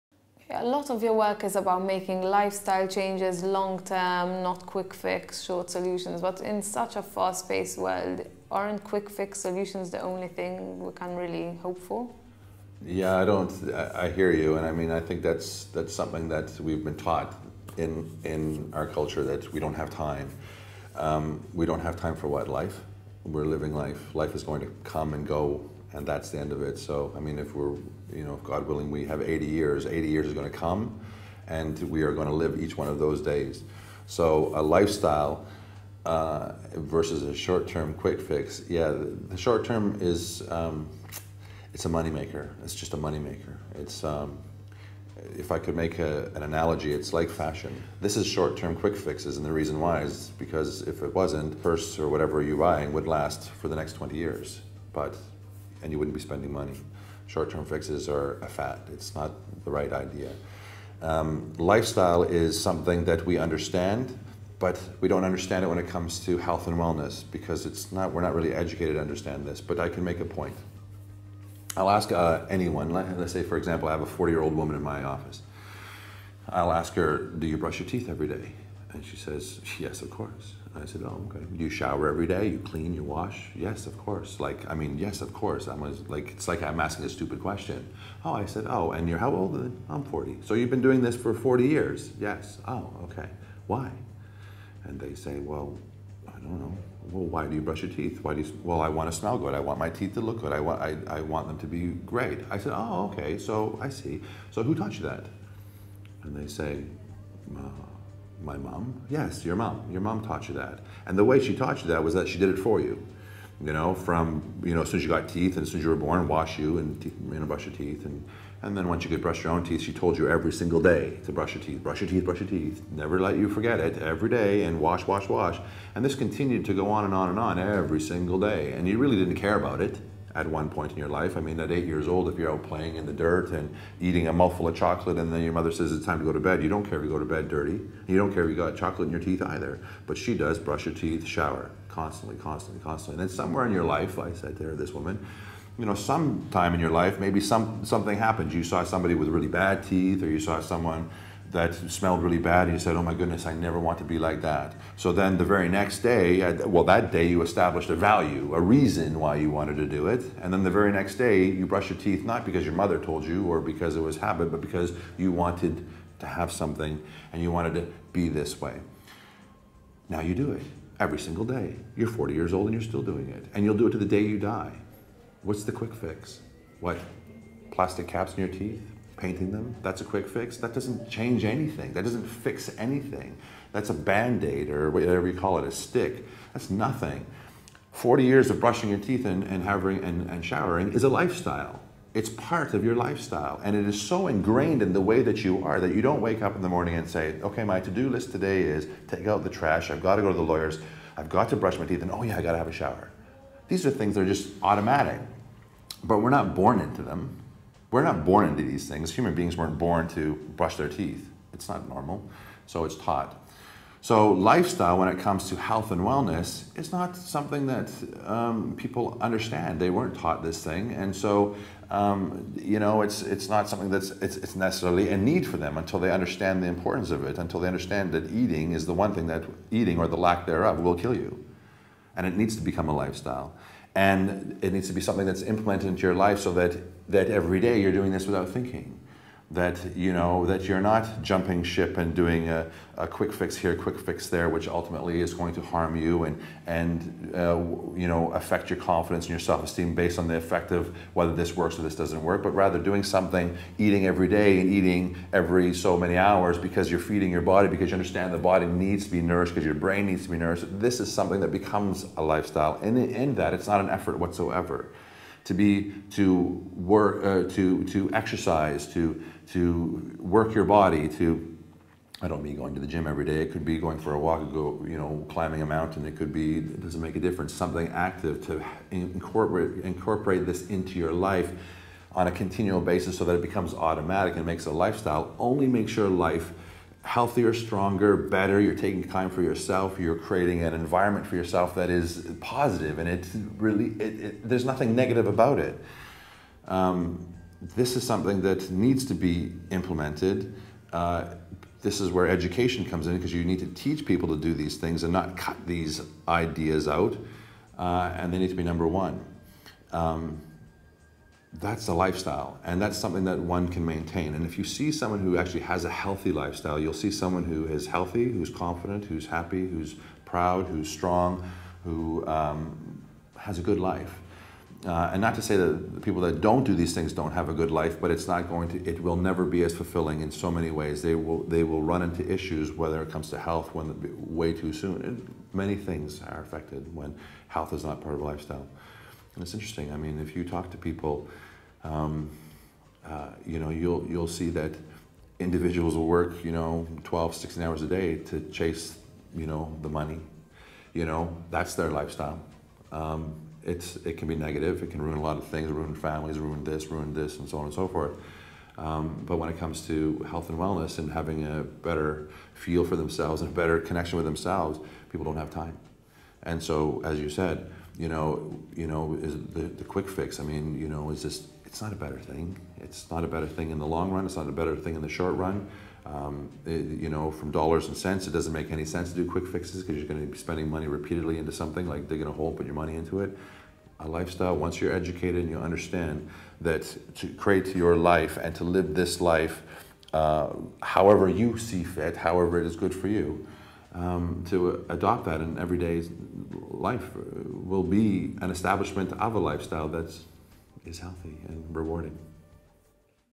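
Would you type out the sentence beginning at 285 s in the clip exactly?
Only make sure life healthier, stronger, better.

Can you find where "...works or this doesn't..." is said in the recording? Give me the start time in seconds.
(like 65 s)
251 s.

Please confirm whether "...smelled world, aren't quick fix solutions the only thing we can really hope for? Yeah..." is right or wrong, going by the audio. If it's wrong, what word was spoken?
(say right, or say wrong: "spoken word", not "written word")
wrong: "paced", not "smelled".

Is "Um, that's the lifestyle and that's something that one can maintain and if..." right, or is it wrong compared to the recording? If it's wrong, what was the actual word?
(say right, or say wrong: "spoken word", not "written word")
right.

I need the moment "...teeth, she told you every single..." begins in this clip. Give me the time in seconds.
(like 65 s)
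119 s.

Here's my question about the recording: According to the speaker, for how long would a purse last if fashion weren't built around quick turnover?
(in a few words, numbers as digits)
20 years.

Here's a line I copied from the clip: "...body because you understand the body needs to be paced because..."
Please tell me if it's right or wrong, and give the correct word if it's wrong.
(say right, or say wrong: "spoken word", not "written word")
wrong: "nourished", not "paced".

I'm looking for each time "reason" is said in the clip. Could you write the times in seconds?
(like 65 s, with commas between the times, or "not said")
49 s, 158 s.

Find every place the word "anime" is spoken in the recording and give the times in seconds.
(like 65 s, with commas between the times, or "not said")
not said.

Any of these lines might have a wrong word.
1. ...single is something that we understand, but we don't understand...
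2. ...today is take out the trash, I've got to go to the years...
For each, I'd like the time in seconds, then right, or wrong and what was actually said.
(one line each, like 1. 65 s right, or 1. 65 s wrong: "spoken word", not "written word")
1. 61 s wrong: "lifestyle", not "single"
2. 198 s wrong: "lawyers", not "years".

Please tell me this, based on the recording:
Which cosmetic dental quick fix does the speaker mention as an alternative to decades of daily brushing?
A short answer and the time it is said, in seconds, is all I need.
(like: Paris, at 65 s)
Plastic caps, at 177 s.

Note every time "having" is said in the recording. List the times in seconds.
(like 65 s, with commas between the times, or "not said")
189 s, 361 s.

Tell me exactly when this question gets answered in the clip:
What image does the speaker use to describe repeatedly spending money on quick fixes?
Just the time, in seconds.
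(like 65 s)
382 s.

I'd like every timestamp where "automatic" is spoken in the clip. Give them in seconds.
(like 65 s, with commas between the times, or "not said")
204 s, 283 s.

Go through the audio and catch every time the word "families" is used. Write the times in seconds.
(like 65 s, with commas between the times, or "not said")
355 s.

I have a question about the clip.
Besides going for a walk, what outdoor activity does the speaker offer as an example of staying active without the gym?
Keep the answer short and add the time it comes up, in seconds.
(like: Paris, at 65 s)
climbing a mountain, at 275 s.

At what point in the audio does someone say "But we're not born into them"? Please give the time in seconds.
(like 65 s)
206 s.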